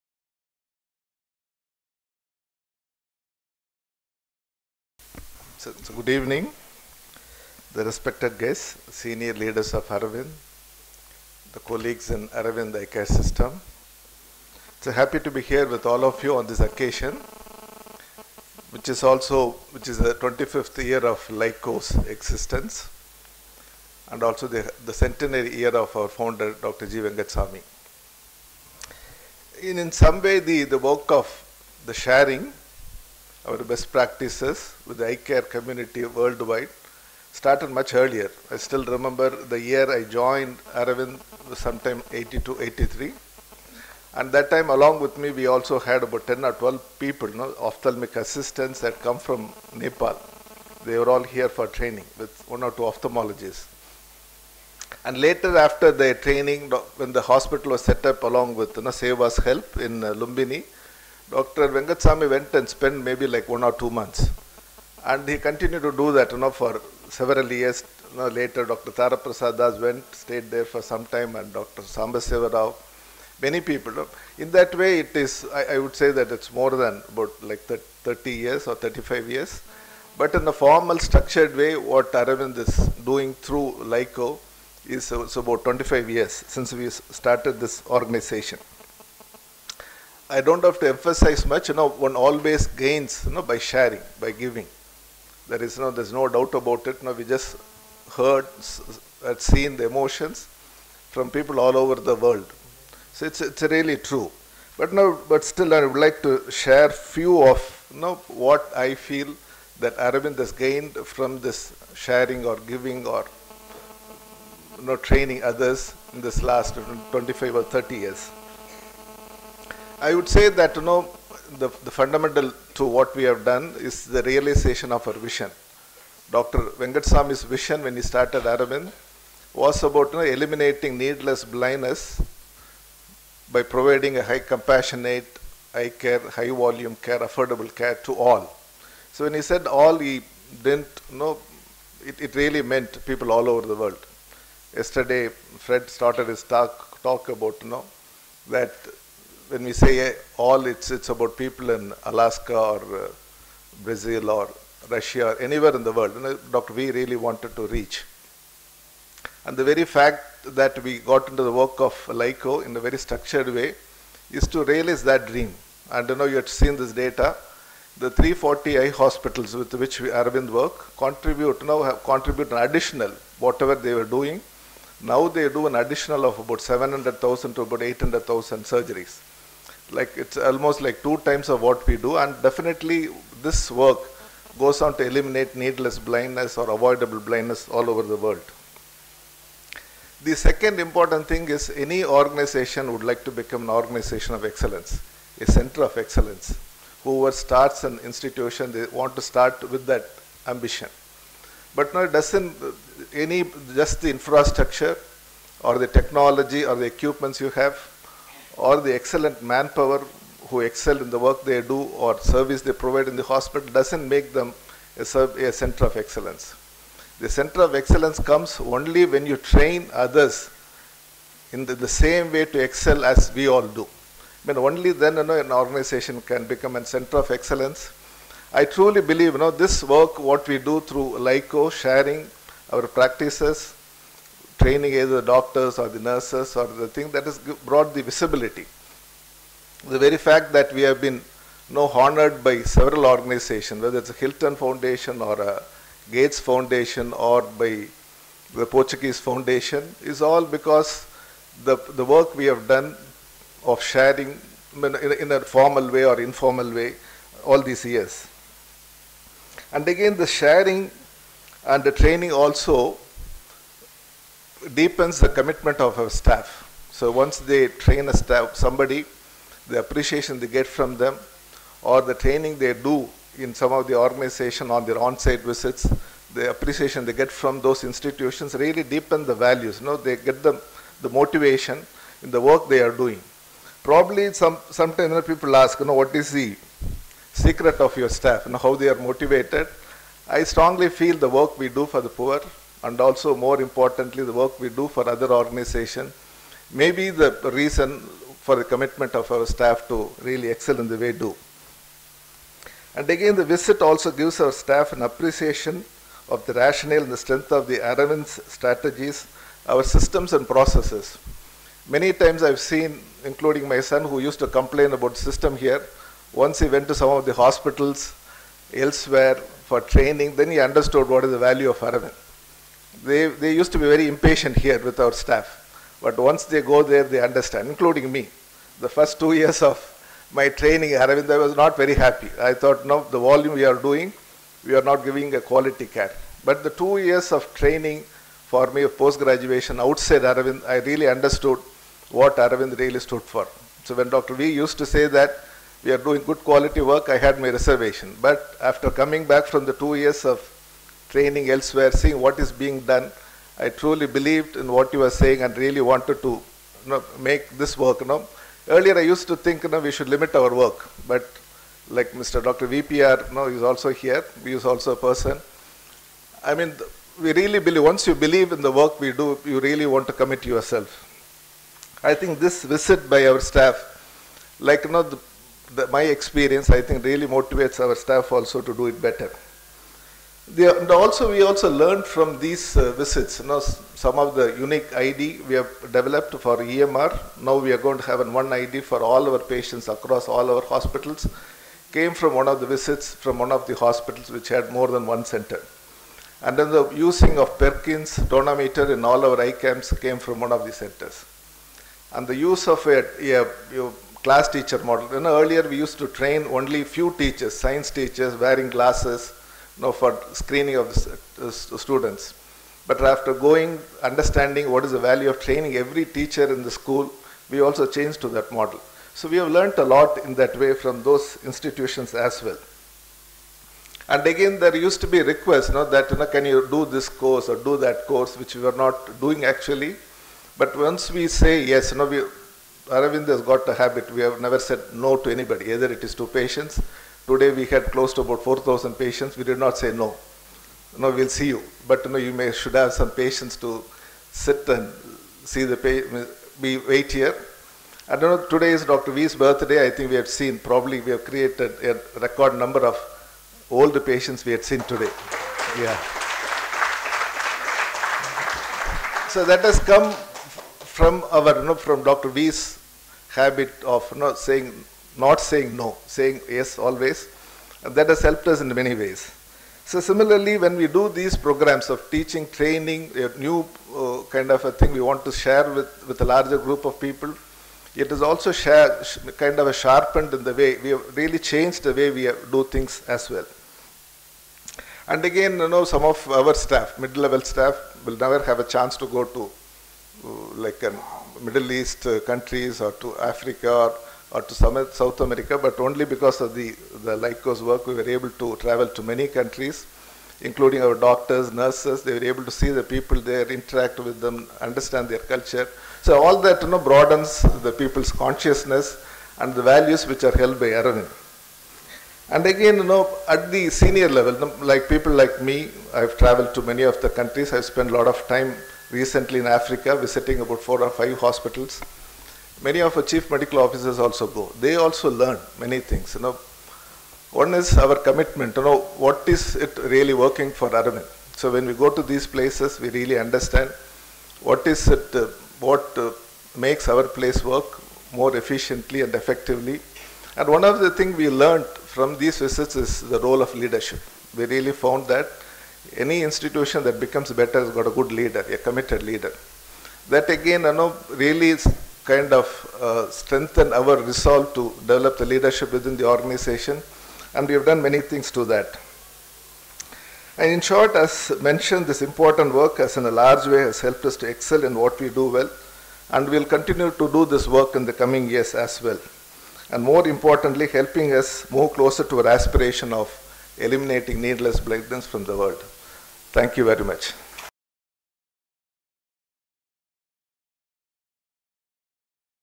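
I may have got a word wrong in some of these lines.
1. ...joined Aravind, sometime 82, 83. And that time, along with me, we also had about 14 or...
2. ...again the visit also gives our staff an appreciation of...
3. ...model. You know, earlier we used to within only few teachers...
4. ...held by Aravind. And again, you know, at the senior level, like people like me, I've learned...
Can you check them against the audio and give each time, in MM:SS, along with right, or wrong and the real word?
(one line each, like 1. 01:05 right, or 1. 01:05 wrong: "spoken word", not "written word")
1. 00:40 wrong: "10", not "14"
2. 05:03 right
3. 06:44 wrong: "train", not "within"
4. 08:30 wrong: "traveled", not "learned".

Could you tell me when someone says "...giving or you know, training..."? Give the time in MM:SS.
01:52.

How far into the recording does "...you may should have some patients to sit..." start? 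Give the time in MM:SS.
07:22.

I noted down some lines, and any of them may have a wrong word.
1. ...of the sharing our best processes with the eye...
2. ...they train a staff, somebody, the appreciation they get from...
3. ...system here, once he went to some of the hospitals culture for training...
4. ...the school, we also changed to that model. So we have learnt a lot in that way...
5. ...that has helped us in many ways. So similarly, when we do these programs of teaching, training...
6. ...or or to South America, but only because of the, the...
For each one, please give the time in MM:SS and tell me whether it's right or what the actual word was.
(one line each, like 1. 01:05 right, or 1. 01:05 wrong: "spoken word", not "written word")
1. 00:31 wrong: "practices", not "processes"
2. 04:27 right
3. 05:15 wrong: "elsewhere", not "culture"
4. 06:56 right
5. 07:47 right
6. 08:13 right.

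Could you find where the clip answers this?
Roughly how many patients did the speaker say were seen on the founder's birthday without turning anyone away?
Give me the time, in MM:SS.
07:18.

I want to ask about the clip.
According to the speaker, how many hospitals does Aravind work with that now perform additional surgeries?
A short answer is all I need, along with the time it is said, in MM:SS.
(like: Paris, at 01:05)
340, at 02:48.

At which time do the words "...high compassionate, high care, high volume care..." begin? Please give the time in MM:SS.
02:14.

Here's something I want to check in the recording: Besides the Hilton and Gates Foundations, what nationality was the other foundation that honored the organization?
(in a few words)
Portuguese.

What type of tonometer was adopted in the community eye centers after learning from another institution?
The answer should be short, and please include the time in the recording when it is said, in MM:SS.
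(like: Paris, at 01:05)
Perkins tonometer, at 06:37.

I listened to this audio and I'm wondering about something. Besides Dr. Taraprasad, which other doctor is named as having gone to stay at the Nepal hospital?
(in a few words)
Dr. Sambasiva Rao.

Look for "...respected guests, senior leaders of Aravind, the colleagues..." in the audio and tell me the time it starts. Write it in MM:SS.
00:07.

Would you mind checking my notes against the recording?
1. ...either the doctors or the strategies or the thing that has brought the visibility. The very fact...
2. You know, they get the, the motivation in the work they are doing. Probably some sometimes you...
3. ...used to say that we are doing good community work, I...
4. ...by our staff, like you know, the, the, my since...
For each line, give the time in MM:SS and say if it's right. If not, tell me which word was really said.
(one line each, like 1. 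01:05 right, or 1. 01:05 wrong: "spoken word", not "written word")
1. 03:55 wrong: "nurses", not "strategies"
2. 04:39 right
3. 05:44 wrong: "quality", not "community"
4. 06:13 wrong: "experience", not "since".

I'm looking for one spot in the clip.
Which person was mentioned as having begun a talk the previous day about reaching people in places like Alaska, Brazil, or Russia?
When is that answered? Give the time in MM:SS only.
02:25.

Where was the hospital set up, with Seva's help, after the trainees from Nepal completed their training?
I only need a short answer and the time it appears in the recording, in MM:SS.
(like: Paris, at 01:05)
Lumbini, at 01:00.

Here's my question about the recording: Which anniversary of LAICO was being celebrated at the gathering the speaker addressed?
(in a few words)
25th year.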